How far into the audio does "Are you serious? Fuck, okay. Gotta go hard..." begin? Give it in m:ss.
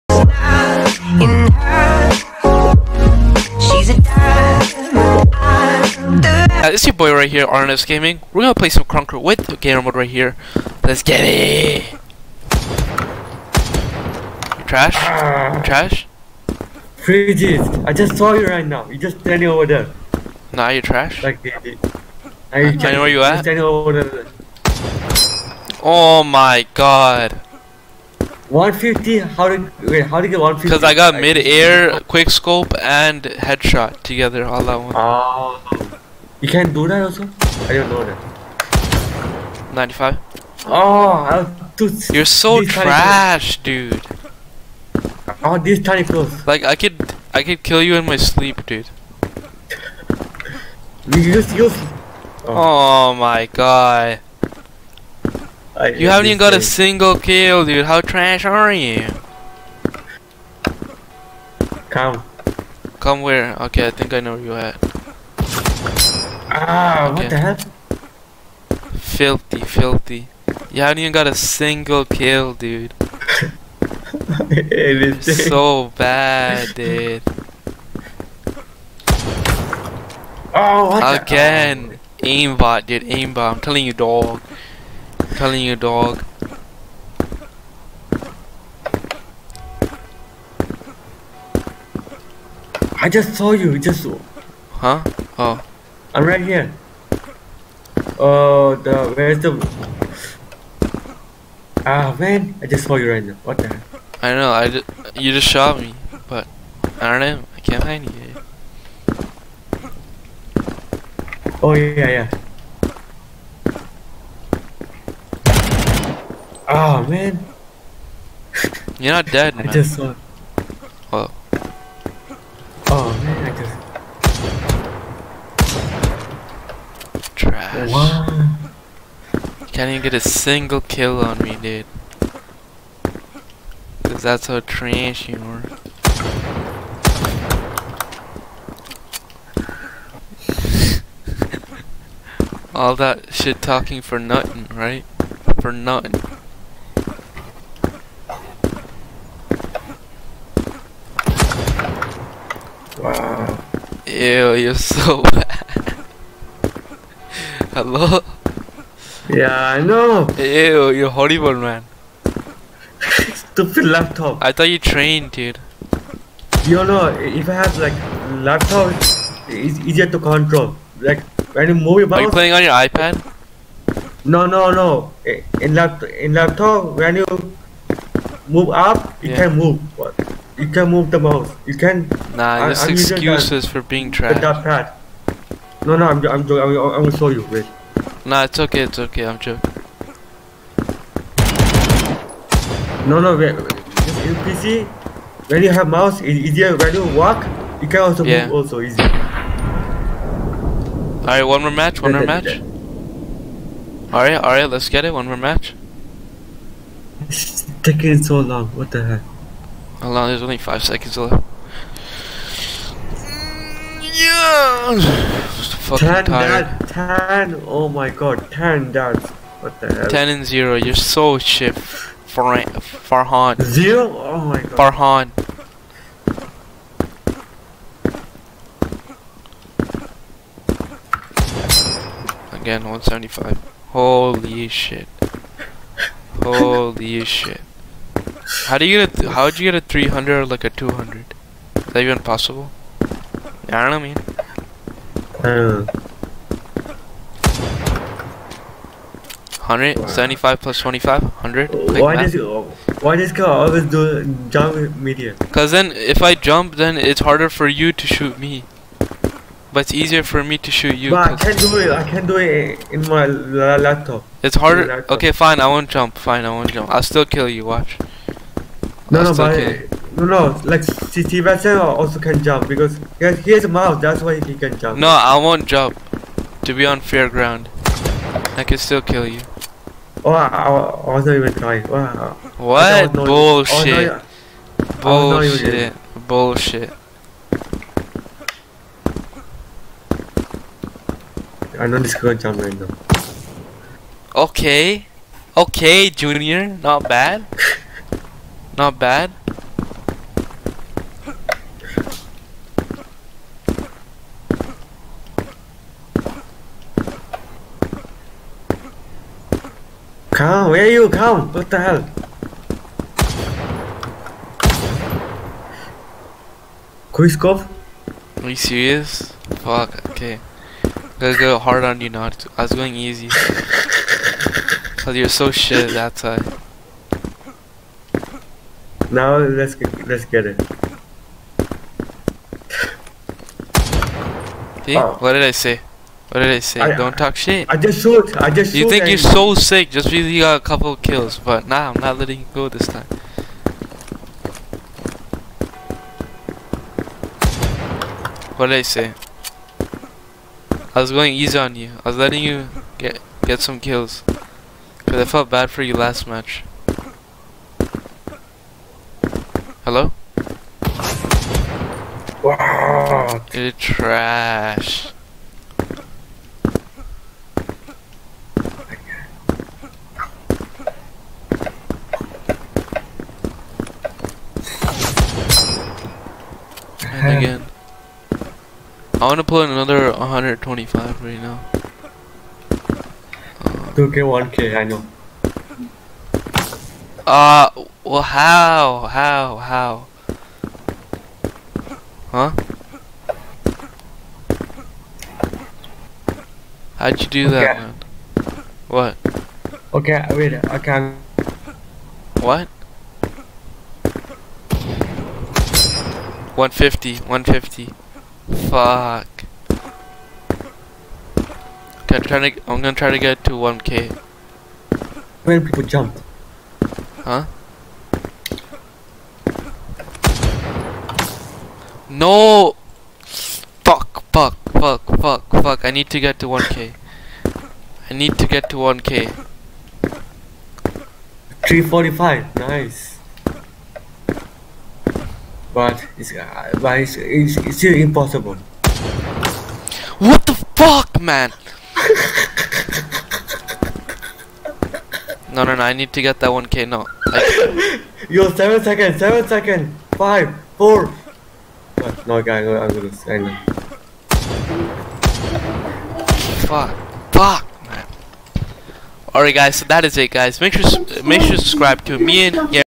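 5:18.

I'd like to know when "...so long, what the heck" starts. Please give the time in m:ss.
3:28.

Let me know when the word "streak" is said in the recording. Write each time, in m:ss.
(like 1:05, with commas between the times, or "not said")
not said.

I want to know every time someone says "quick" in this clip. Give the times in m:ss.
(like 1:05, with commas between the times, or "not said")
0:32, 5:17.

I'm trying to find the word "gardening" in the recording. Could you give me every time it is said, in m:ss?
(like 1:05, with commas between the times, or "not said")
not said.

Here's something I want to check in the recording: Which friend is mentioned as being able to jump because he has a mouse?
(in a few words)
Sebastian.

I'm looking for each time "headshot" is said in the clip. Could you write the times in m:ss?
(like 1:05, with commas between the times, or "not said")
0:33.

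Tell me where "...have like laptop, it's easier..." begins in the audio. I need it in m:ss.
2:47.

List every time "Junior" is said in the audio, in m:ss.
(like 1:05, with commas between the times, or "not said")
4:56.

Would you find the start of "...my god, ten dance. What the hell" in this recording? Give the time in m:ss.
3:37.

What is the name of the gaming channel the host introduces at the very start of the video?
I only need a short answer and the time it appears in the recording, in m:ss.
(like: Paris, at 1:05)
R&S Gaming, at 0:07.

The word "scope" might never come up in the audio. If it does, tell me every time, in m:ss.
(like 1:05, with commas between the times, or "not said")
0:32, 5:17.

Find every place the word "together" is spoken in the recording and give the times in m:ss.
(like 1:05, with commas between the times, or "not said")
0:34.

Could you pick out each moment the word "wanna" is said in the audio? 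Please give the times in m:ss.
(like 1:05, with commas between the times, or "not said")
6:19.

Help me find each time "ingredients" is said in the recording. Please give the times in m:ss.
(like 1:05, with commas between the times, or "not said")
not said.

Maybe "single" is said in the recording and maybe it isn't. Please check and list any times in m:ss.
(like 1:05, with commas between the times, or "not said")
0:56, 1:11, 2:10.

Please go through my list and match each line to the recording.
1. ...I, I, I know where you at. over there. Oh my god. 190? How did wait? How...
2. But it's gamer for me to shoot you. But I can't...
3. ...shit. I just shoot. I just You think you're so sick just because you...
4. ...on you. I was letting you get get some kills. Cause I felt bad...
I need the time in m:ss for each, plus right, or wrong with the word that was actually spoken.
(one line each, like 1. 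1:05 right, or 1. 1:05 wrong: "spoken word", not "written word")
1. 0:22 wrong: "150", not "190"
2. 4:19 wrong: "easier", not "gamer"
3. 5:37 right
4. 5:51 right.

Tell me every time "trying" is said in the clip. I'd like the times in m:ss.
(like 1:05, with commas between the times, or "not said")
4:41, 6:52.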